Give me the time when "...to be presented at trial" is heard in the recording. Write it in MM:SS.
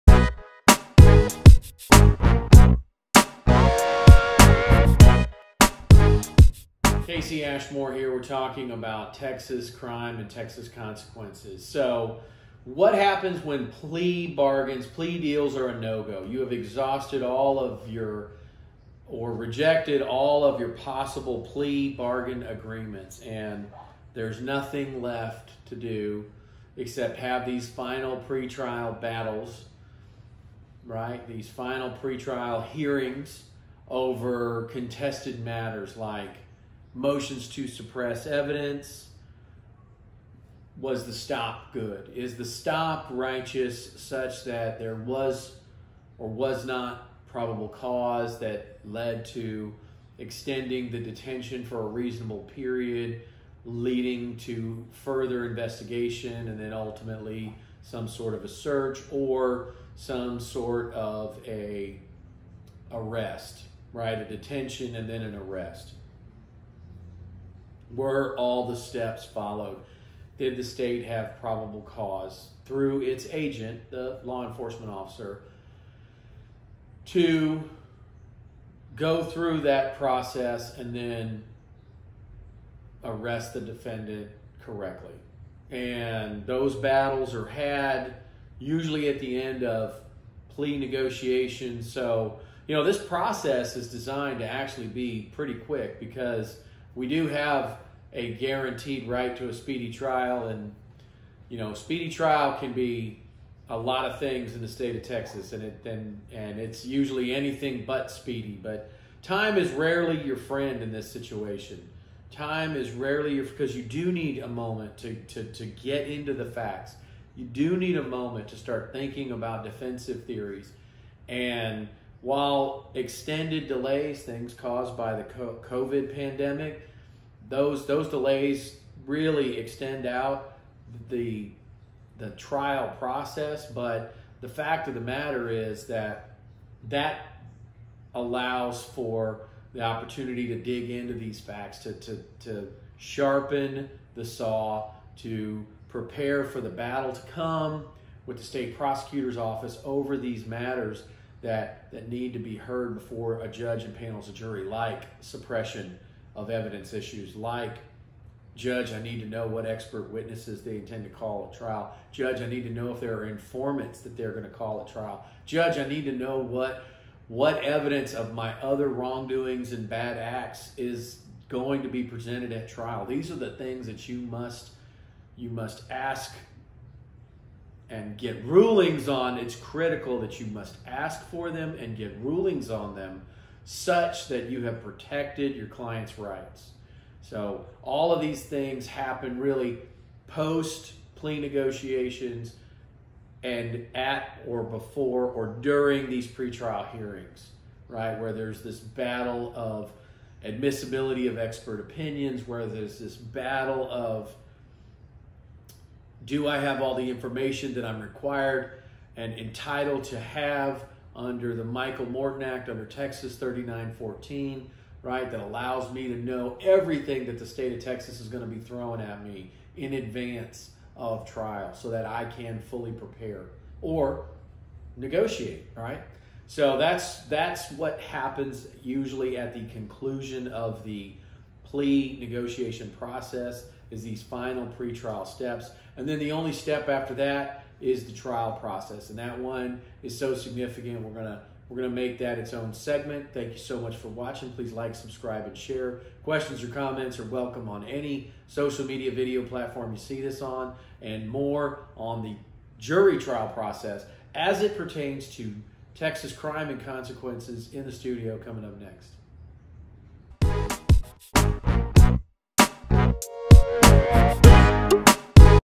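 02:51.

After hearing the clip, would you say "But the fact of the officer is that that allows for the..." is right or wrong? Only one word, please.
wrong.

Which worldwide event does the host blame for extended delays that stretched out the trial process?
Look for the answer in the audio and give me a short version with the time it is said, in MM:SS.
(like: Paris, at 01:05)
COVID pandemic, at 02:05.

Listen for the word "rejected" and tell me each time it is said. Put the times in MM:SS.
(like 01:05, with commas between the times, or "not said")
00:19.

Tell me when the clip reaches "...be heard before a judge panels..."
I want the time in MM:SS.
02:32.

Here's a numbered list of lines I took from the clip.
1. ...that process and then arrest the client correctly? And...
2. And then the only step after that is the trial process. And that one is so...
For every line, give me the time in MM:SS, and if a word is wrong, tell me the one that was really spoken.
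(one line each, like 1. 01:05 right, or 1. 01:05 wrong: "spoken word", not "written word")
1. 01:19 wrong: "defendant", not "client"
2. 03:55 right.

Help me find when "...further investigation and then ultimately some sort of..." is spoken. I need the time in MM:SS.
00:54.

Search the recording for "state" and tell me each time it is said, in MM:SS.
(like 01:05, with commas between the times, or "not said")
01:10, 01:44, 02:28, 03:37.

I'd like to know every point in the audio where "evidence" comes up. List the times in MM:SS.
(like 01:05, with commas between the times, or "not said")
00:38, 02:36, 02:47.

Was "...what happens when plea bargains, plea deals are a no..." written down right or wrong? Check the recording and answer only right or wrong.
right.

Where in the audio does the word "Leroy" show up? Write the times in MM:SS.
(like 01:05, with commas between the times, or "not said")
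not said.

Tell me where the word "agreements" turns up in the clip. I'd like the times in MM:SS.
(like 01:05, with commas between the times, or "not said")
00:22.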